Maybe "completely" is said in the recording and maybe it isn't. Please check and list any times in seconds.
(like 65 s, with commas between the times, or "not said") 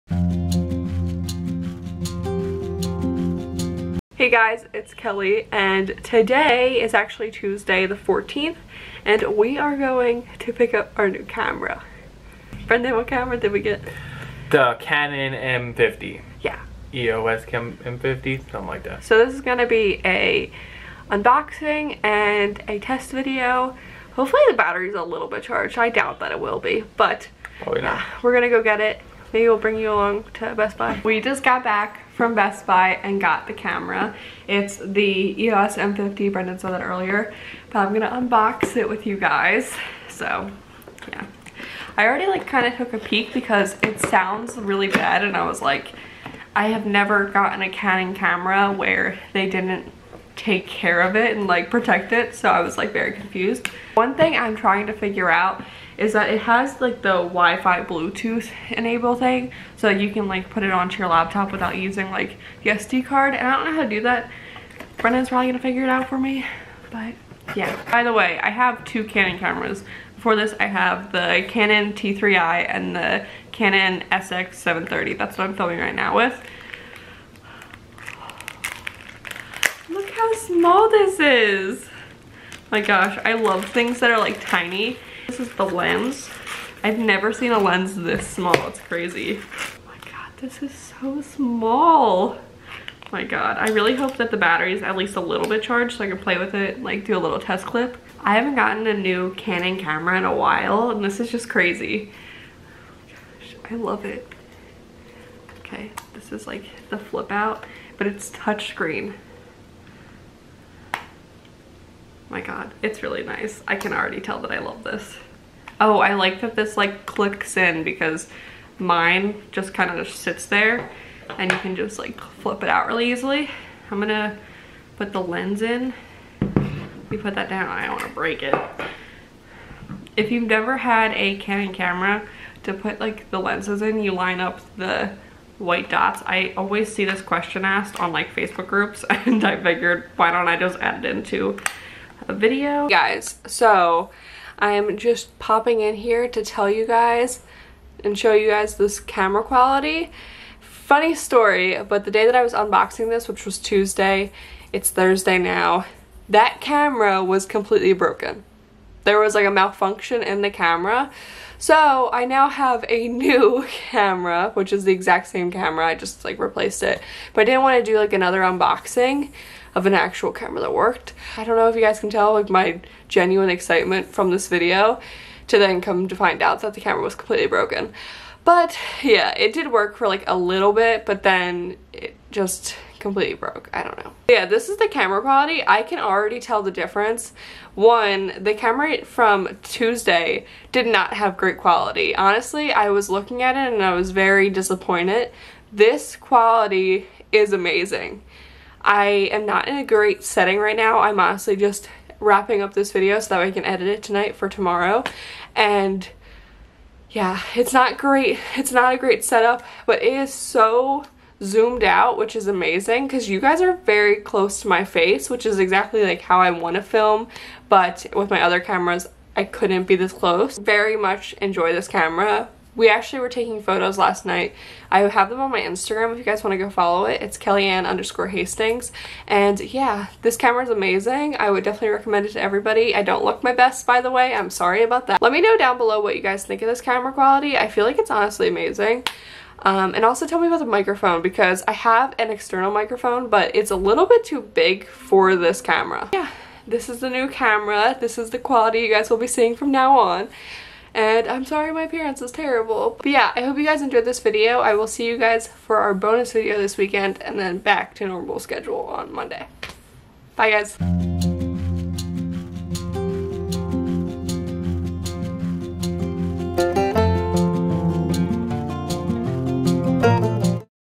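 157 s, 177 s, 183 s.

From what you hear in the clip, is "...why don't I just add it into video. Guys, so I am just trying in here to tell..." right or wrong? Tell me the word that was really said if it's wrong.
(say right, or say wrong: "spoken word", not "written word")
wrong: "popping", not "trying".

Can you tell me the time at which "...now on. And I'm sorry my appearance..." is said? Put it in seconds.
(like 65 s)
249 s.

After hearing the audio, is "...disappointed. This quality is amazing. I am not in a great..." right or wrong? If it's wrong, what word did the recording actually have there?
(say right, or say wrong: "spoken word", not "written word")
right.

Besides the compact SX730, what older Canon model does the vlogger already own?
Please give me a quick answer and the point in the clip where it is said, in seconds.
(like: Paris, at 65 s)
Canon T3i, at 71 s.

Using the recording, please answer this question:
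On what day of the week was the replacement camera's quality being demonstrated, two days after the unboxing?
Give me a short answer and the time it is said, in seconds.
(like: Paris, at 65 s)
Thursday, at 154 s.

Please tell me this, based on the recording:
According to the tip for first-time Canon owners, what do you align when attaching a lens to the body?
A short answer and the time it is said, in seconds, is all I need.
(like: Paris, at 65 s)
the white dots, at 135 s.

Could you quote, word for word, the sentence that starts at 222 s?
We actually were taking photos last night.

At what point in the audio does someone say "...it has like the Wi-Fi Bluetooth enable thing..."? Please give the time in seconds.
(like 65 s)
56 s.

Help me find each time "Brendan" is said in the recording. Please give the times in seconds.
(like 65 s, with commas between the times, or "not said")
12 s, 36 s, 64 s.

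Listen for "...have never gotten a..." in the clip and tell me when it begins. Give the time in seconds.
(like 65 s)
46 s.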